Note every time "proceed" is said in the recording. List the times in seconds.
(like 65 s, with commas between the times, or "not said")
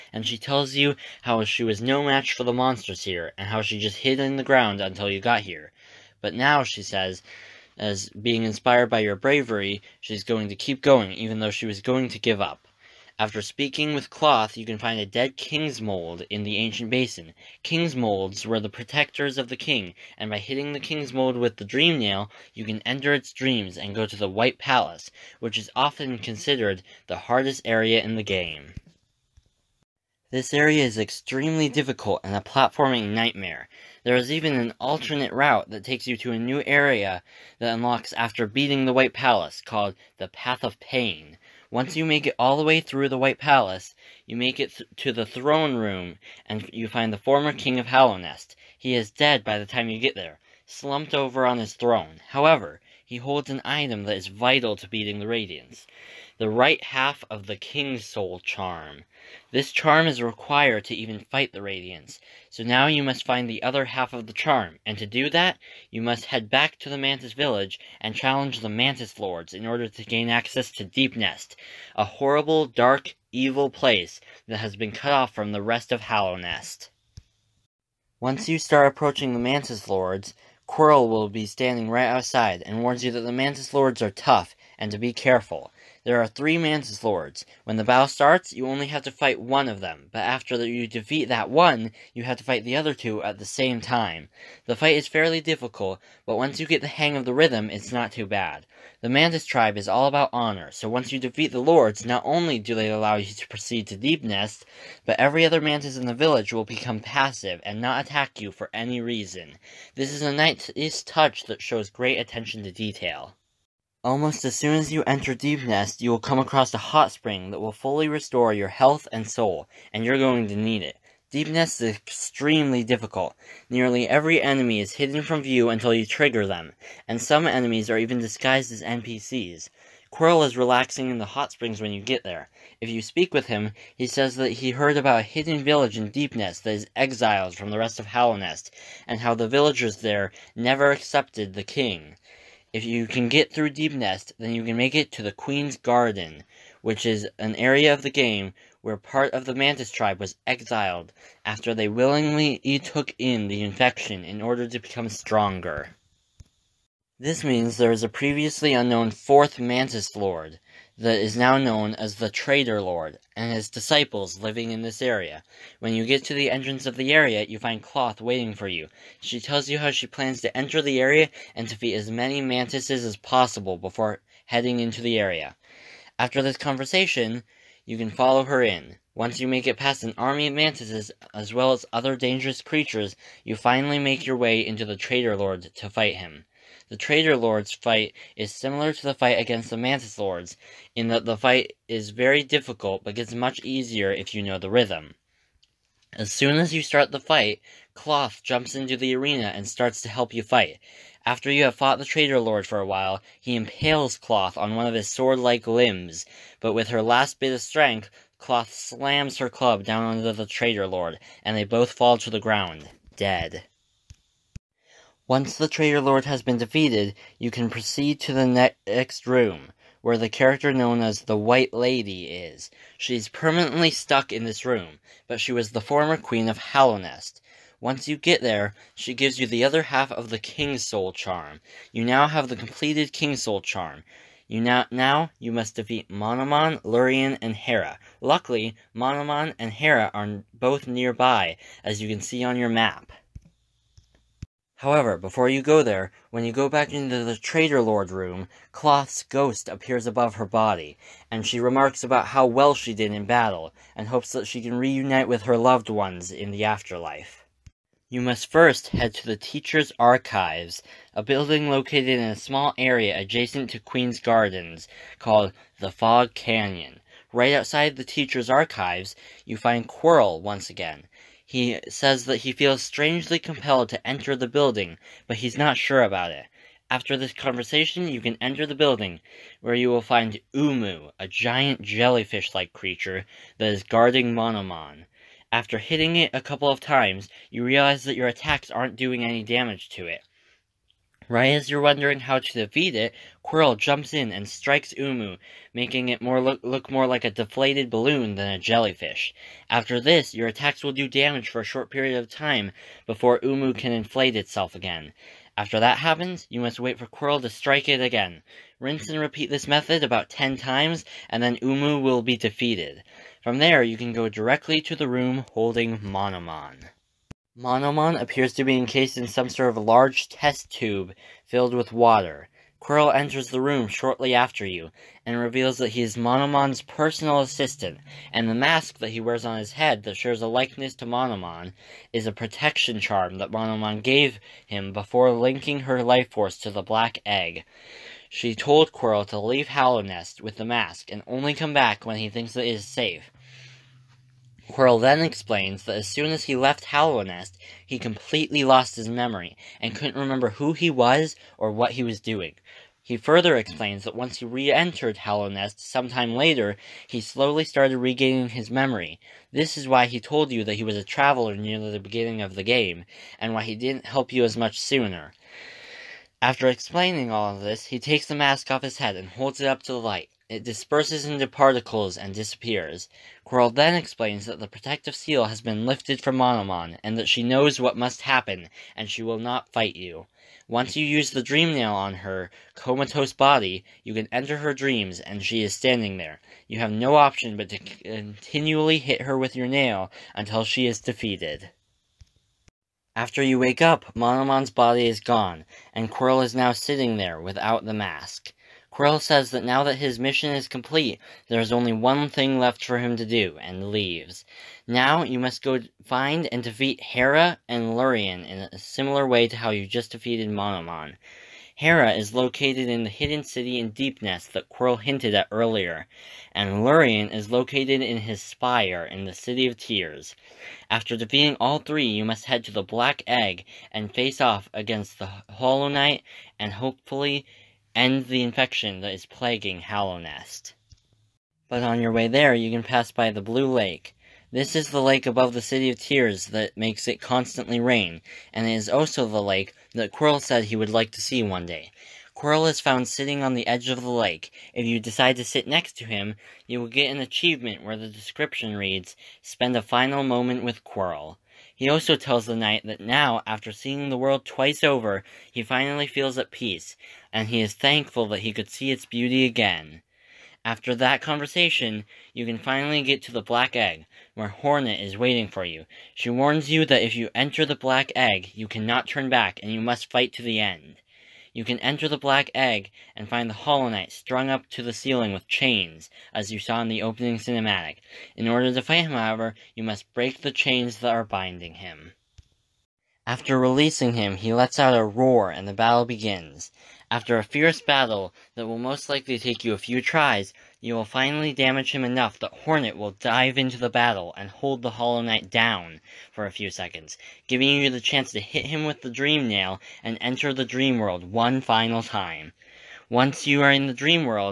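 103 s, 217 s.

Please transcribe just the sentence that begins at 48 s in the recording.
He is dead by the time you get there, slumped over on his throne.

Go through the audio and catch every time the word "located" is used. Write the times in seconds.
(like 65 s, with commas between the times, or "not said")
261 s, 412 s, 417 s.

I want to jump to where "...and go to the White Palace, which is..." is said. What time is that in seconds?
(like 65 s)
23 s.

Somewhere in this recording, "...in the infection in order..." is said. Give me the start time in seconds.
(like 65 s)
153 s.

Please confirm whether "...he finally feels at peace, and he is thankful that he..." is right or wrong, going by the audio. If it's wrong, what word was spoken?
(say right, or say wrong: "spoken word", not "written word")
right.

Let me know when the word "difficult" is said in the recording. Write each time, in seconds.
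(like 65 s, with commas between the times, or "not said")
31 s, 95 s, 122 s, 192 s.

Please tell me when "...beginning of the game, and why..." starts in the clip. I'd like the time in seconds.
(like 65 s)
361 s.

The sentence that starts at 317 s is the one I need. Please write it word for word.
Monomon appears to be encased in some sort of large test tube filled with water.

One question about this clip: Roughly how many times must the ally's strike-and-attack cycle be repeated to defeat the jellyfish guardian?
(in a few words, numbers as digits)
10.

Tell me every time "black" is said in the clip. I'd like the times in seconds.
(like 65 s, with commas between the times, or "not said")
336 s, 422 s, 463 s, 467 s, 472 s.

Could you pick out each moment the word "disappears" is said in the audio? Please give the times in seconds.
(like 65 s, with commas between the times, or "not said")
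372 s.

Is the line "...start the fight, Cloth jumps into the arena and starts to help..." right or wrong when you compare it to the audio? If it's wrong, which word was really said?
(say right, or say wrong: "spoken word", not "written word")
right.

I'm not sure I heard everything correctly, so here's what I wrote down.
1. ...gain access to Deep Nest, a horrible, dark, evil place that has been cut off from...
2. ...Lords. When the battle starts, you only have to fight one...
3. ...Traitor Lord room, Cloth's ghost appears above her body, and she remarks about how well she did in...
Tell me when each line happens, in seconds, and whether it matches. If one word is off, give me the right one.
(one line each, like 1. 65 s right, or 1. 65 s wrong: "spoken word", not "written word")
1. 70 s right
2. 87 s right
3. 247 s right.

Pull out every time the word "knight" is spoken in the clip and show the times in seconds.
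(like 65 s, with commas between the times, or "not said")
425 s, 452 s, 473 s, 495 s.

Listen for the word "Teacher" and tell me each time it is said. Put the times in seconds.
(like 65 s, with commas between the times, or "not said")
259 s, 268 s.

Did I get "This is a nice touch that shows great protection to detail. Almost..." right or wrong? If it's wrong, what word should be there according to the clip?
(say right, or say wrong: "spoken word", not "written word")
wrong: "attention", not "protection".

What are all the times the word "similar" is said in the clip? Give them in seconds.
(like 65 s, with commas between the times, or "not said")
188 s, 408 s.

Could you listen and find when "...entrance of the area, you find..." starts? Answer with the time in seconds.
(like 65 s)
166 s.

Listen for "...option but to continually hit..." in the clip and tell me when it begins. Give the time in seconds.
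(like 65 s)
387 s.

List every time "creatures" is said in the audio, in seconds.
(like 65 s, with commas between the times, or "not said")
182 s, 282 s.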